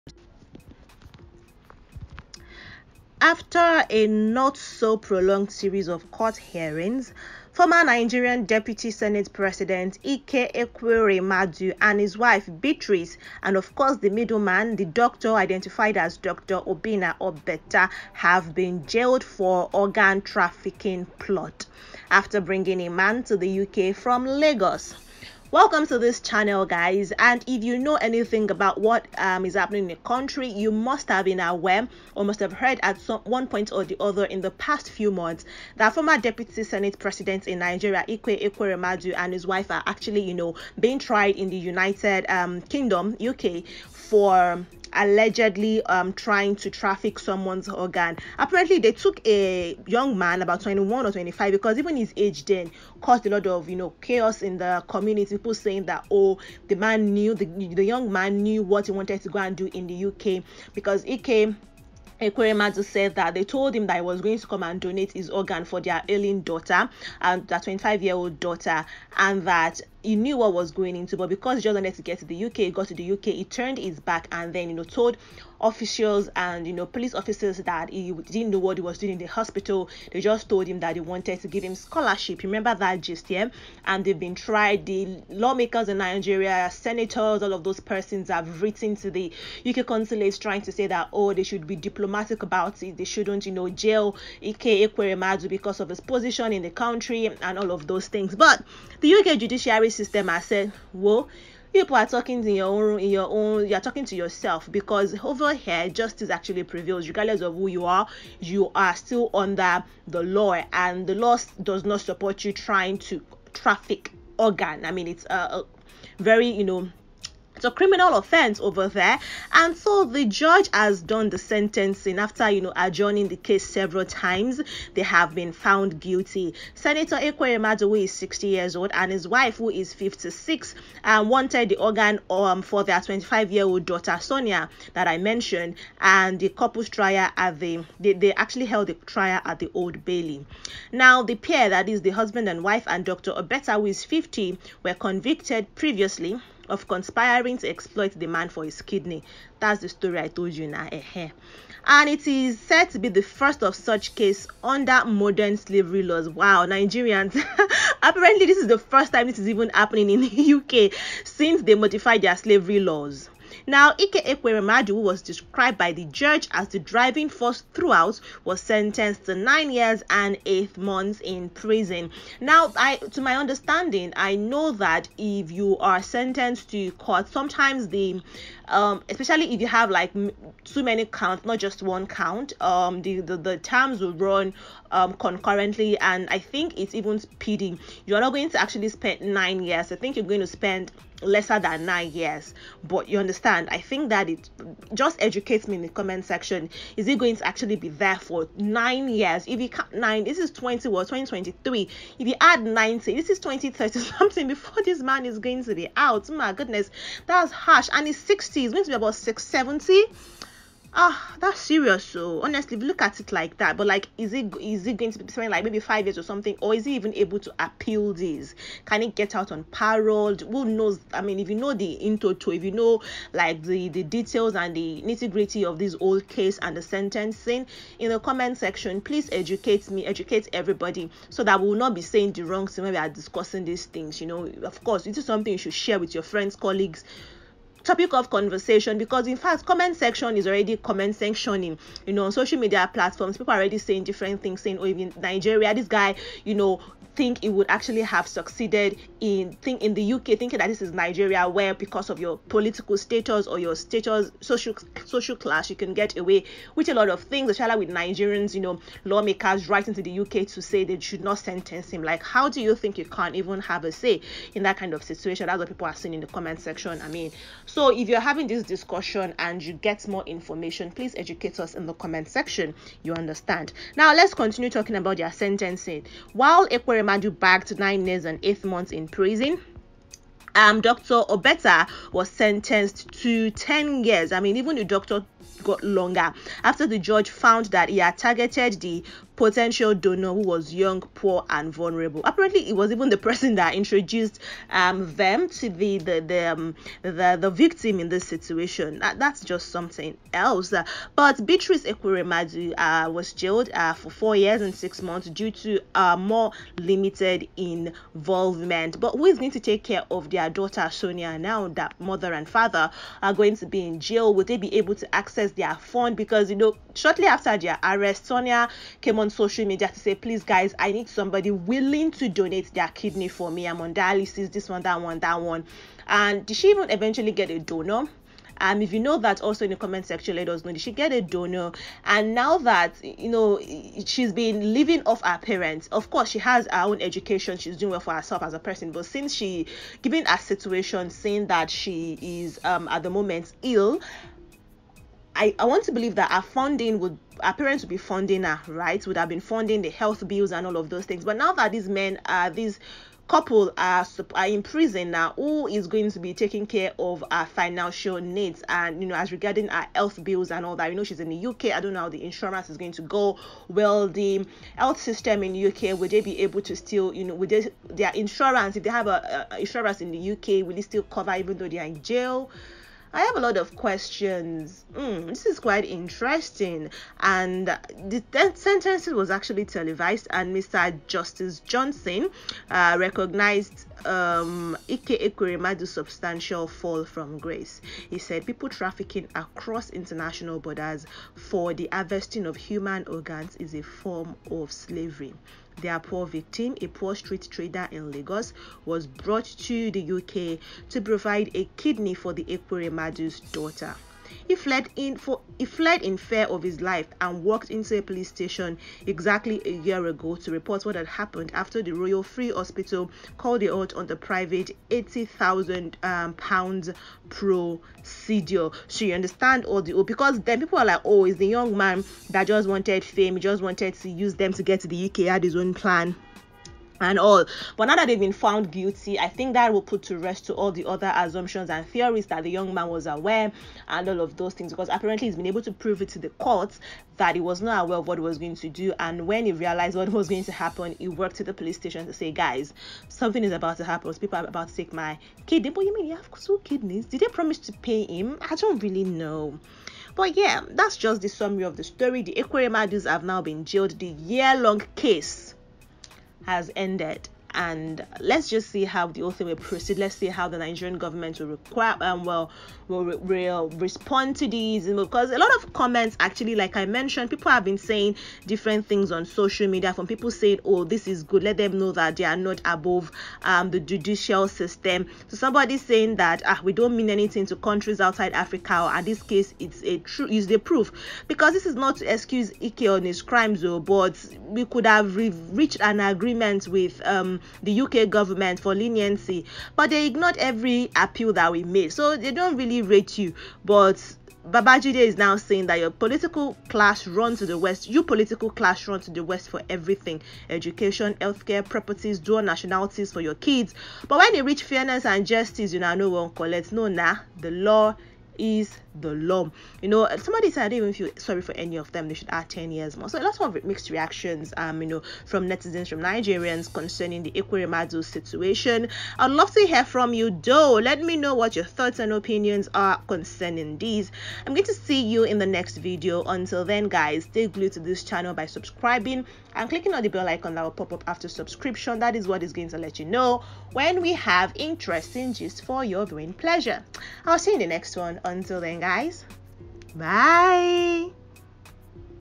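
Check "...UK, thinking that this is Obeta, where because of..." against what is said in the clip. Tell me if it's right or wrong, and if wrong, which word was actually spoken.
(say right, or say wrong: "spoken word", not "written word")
wrong: "Nigeria", not "Obeta".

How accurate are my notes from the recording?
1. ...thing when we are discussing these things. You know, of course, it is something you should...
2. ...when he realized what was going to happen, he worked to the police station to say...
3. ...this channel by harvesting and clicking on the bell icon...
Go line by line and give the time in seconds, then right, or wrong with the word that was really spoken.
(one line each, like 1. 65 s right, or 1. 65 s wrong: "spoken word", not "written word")
1. 232 s right
2. 439 s right
3. 527 s wrong: "subscribing", not "harvesting".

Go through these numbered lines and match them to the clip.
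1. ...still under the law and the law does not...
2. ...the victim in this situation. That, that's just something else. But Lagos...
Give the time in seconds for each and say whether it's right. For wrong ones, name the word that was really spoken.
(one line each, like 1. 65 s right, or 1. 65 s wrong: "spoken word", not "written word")
1. 108 s right
2. 297 s wrong: "Beatrice", not "Lagos".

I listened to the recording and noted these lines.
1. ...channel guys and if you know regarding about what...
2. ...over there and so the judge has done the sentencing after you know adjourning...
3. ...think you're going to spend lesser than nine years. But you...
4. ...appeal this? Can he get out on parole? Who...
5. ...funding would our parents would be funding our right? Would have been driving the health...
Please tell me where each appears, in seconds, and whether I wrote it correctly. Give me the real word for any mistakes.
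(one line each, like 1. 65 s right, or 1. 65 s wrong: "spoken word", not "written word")
1. 26 s wrong: "anything", not "regarding"
2. 118 s right
3. 189 s right
4. 217 s right
5. 346 s wrong: "funding", not "driving".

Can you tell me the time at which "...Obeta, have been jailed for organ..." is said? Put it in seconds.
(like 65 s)
17 s.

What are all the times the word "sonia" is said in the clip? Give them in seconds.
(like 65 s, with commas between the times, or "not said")
134 s, 310 s, 318 s.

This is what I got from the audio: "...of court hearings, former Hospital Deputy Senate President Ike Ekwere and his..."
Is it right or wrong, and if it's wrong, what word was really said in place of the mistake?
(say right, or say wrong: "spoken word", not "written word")
wrong: "Nigerian", not "Hospital".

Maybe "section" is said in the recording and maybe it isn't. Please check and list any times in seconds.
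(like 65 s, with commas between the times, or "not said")
196 s, 228 s, 239 s, 266 s, 272 s, 330 s.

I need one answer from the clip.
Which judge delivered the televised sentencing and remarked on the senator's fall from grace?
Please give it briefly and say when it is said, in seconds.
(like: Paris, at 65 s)
Mr. Justice Johnson, at 380 s.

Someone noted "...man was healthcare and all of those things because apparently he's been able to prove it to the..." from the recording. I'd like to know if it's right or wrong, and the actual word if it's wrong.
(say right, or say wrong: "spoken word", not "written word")
wrong: "aware", not "healthcare".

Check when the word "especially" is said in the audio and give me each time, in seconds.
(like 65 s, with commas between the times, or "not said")
179 s, 257 s.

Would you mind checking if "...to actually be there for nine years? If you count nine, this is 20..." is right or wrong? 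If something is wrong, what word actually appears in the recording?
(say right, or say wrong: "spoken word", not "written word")
right.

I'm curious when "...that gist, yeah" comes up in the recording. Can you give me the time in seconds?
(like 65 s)
82 s.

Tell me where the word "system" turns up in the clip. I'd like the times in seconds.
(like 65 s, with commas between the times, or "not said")
99 s, 364 s, 474 s.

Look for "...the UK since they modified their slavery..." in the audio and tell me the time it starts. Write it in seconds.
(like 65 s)
160 s.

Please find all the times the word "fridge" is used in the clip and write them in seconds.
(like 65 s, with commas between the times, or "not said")
not said.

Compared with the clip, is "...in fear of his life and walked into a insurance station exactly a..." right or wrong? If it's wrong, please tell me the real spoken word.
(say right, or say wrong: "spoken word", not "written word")
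wrong: "police", not "insurance".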